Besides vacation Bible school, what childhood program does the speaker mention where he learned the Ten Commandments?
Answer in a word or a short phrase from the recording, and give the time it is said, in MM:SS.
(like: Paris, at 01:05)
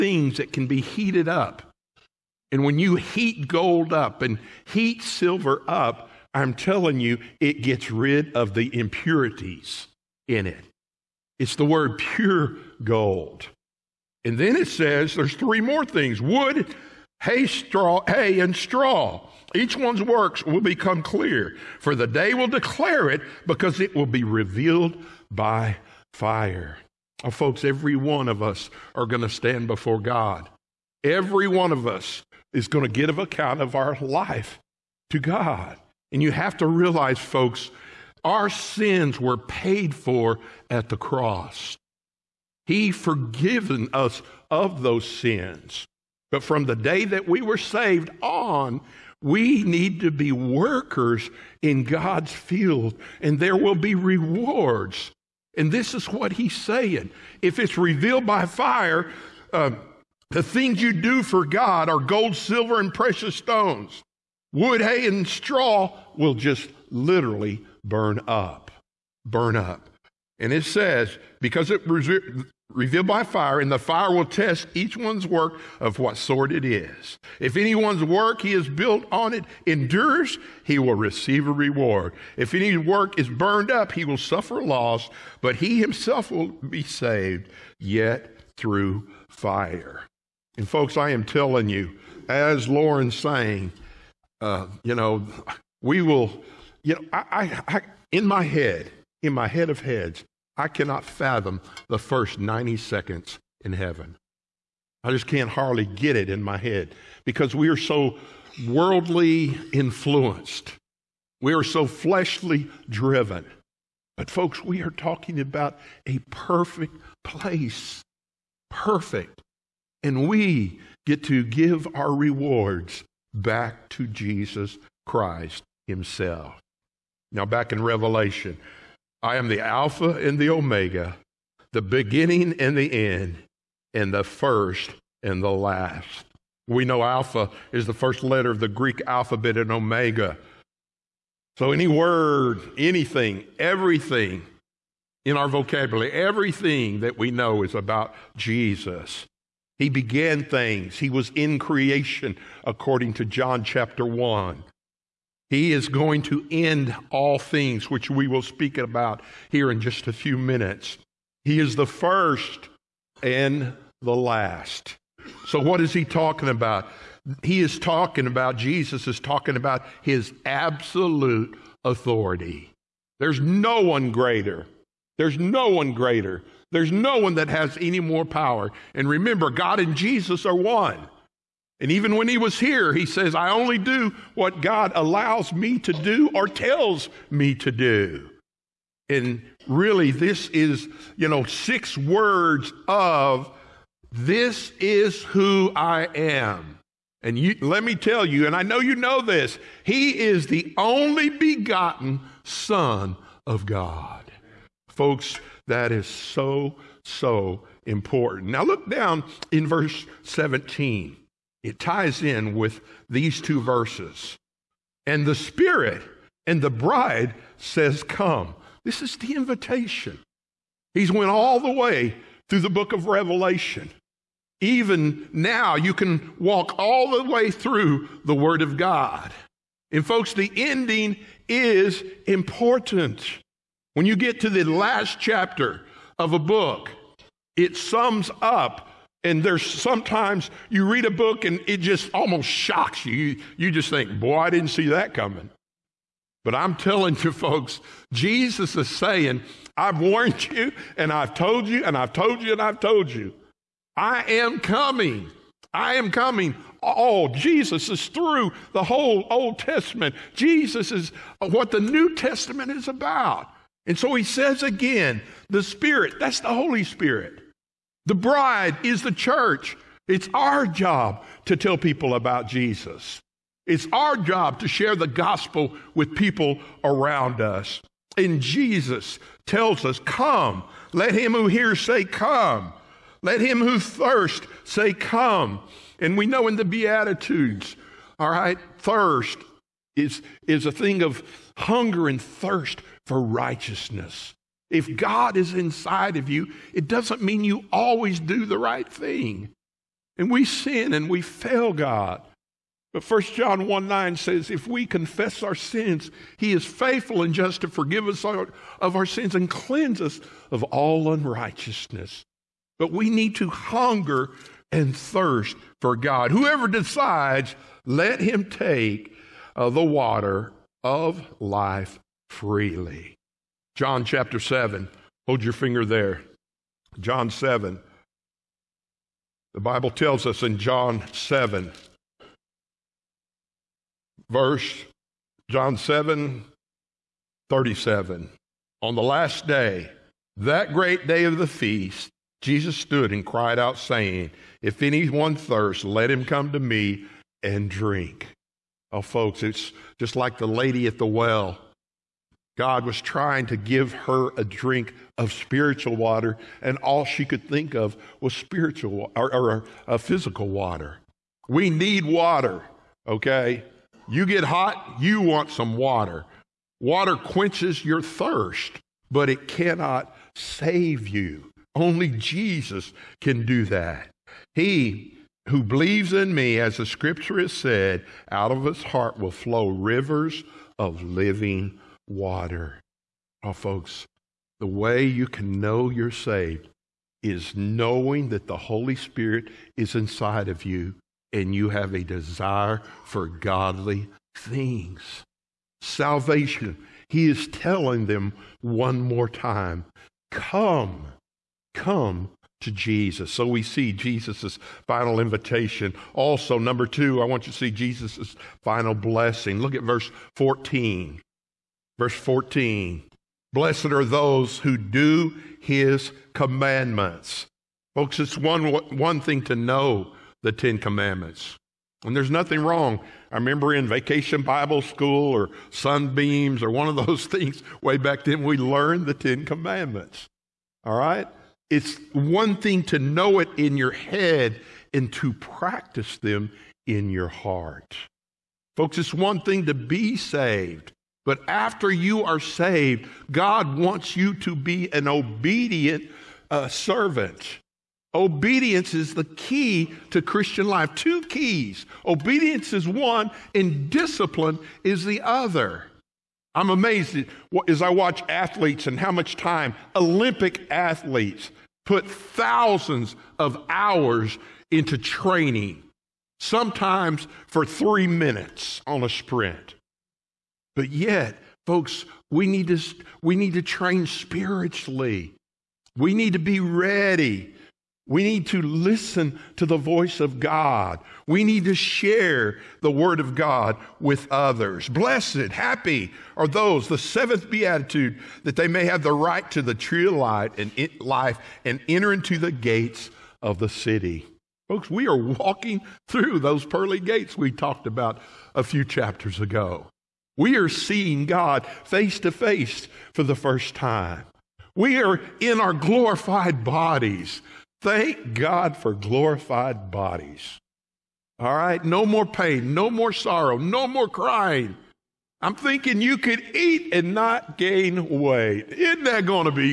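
Sunbeams, at 07:05.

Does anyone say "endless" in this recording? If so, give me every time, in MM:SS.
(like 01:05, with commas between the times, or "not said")
not said.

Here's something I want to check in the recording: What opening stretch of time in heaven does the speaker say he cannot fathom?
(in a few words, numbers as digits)
The first 90 seconds.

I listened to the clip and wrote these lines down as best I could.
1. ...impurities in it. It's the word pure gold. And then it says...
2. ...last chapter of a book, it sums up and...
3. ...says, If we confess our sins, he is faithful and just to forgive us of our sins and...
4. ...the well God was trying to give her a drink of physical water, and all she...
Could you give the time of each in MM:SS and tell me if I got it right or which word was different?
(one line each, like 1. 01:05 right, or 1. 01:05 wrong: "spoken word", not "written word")
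1. 00:08 right
2. 03:54 right
3. 05:04 right
4. 05:50 wrong: "spiritual", not "physical".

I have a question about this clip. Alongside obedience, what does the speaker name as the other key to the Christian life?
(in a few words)
Discipline.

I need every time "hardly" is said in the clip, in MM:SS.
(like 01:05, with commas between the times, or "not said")
01:45.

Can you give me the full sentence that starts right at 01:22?
If any work is burned up, he will suffer loss, but he himself will be saved, yet through fire.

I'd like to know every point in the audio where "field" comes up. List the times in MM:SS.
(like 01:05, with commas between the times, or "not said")
00:52.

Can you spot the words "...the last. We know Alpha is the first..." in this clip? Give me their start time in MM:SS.
02:15.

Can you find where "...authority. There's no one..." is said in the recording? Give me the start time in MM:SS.
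02:51.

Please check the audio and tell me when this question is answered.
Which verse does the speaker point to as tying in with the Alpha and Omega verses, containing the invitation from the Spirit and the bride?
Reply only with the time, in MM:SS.
03:29.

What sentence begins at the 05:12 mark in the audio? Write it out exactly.
But we need to hunger and thirst for God.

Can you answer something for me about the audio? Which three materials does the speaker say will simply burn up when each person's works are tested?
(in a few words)
Wood, hay, and straw.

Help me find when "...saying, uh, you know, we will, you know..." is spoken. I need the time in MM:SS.
01:33.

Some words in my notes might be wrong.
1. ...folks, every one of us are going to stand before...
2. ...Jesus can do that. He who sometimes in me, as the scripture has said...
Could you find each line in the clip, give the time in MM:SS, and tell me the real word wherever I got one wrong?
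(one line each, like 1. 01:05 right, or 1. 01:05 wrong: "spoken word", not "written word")
1. 00:27 right
2. 06:12 wrong: "believes", not "sometimes".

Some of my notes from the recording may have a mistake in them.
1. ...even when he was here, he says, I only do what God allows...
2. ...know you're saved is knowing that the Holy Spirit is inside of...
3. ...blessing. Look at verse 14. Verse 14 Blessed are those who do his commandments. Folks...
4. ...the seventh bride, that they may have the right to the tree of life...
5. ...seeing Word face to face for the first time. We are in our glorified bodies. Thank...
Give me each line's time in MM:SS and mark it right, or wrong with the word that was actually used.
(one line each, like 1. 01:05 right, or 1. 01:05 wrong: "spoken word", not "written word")
1. 03:01 right
2. 06:25 right
3. 06:48 right
4. 08:06 wrong: "beatitude", not "bride"
5. 08:20 wrong: "God", not "Word".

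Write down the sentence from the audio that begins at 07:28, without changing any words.
Obedience is the key to Christian life.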